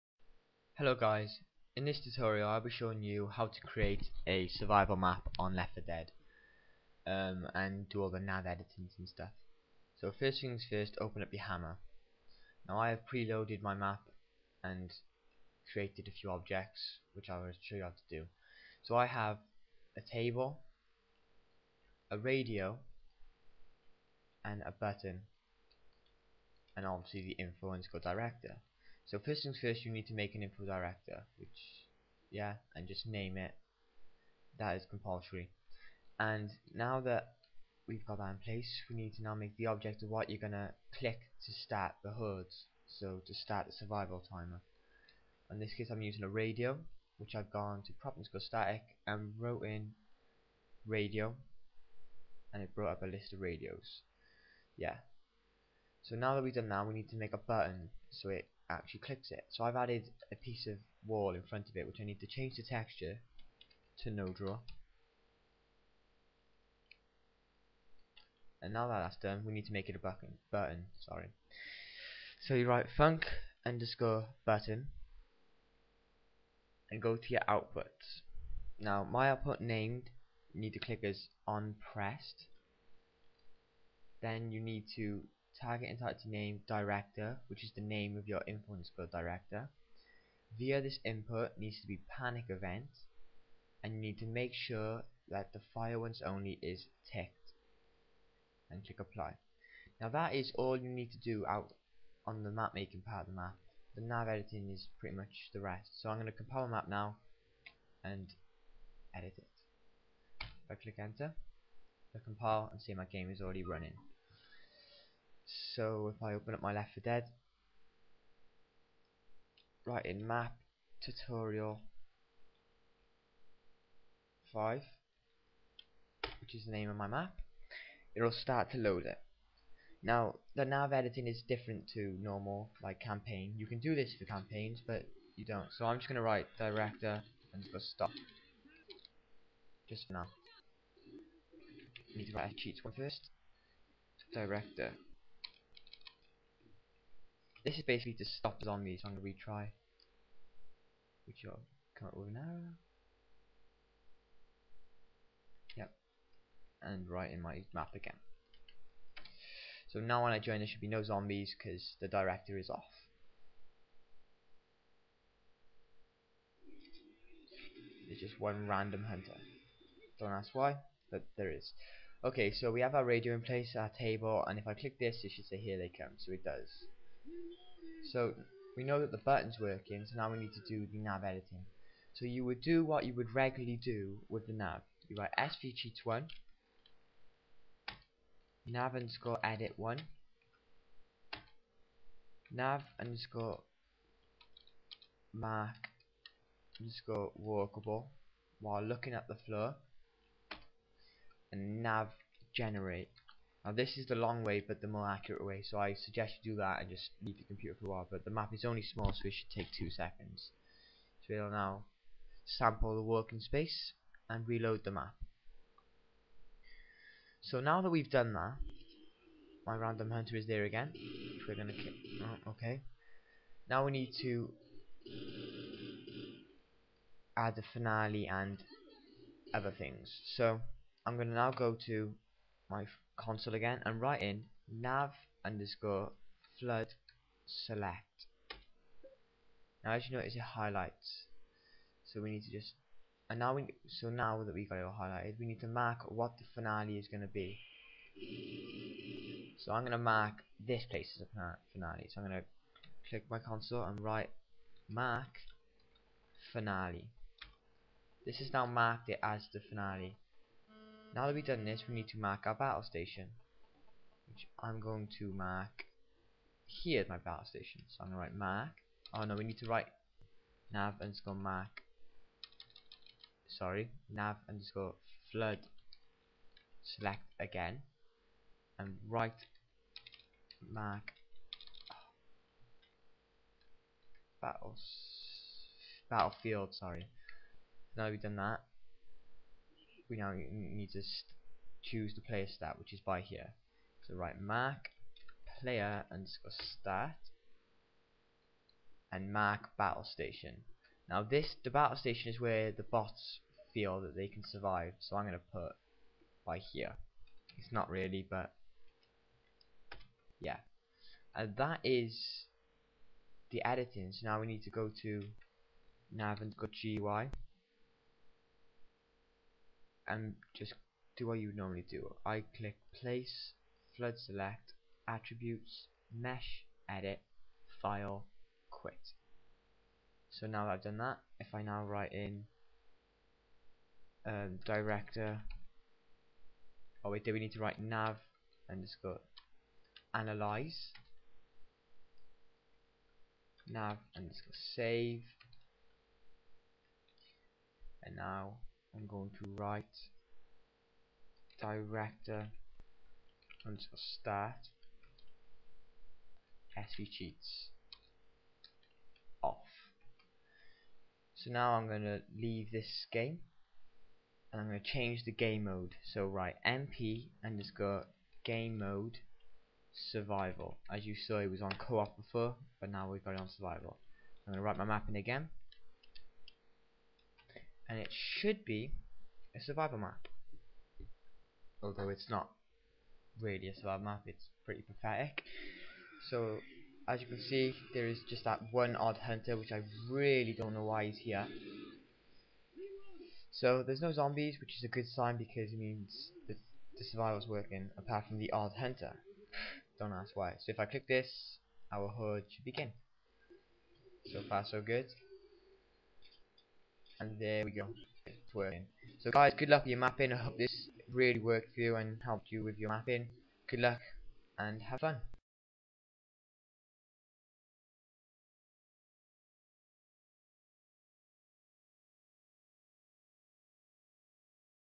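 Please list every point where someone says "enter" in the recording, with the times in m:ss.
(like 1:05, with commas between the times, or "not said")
1:50.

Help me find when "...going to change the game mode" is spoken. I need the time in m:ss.
6:04.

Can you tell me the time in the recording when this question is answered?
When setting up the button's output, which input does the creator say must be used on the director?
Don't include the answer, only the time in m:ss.
1:32.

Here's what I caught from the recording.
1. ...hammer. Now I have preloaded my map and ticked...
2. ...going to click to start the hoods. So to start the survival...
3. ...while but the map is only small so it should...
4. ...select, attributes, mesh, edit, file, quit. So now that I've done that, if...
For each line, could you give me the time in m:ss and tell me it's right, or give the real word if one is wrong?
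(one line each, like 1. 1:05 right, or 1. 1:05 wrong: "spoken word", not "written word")
1. 0:11 wrong: "created", not "ticked"
2. 0:40 right
3. 3:27 right
4. 5:24 right.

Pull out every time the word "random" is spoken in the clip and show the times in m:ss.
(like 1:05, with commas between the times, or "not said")
2:48, 3:39.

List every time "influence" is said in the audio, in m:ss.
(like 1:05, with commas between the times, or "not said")
0:27, 1:28.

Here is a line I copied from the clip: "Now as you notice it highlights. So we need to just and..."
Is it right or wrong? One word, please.
right.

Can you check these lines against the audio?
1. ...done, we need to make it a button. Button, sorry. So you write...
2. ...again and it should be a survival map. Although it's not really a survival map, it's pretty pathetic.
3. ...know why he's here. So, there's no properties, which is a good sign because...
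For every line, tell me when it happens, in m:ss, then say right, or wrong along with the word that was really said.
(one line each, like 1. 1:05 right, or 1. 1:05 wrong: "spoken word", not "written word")
1. 1:09 right
2. 6:15 right
3. 6:30 wrong: "zombies", not "properties".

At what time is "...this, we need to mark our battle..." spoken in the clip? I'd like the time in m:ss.
4:21.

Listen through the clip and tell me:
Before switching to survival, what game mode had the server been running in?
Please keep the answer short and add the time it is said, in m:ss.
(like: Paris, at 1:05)
Co-op, at 6:11.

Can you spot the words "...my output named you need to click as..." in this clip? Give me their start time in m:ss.
1:19.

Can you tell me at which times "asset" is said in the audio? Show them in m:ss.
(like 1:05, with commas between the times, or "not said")
not said.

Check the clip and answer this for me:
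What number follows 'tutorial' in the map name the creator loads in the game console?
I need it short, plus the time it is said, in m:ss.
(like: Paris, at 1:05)
5, at 2:04.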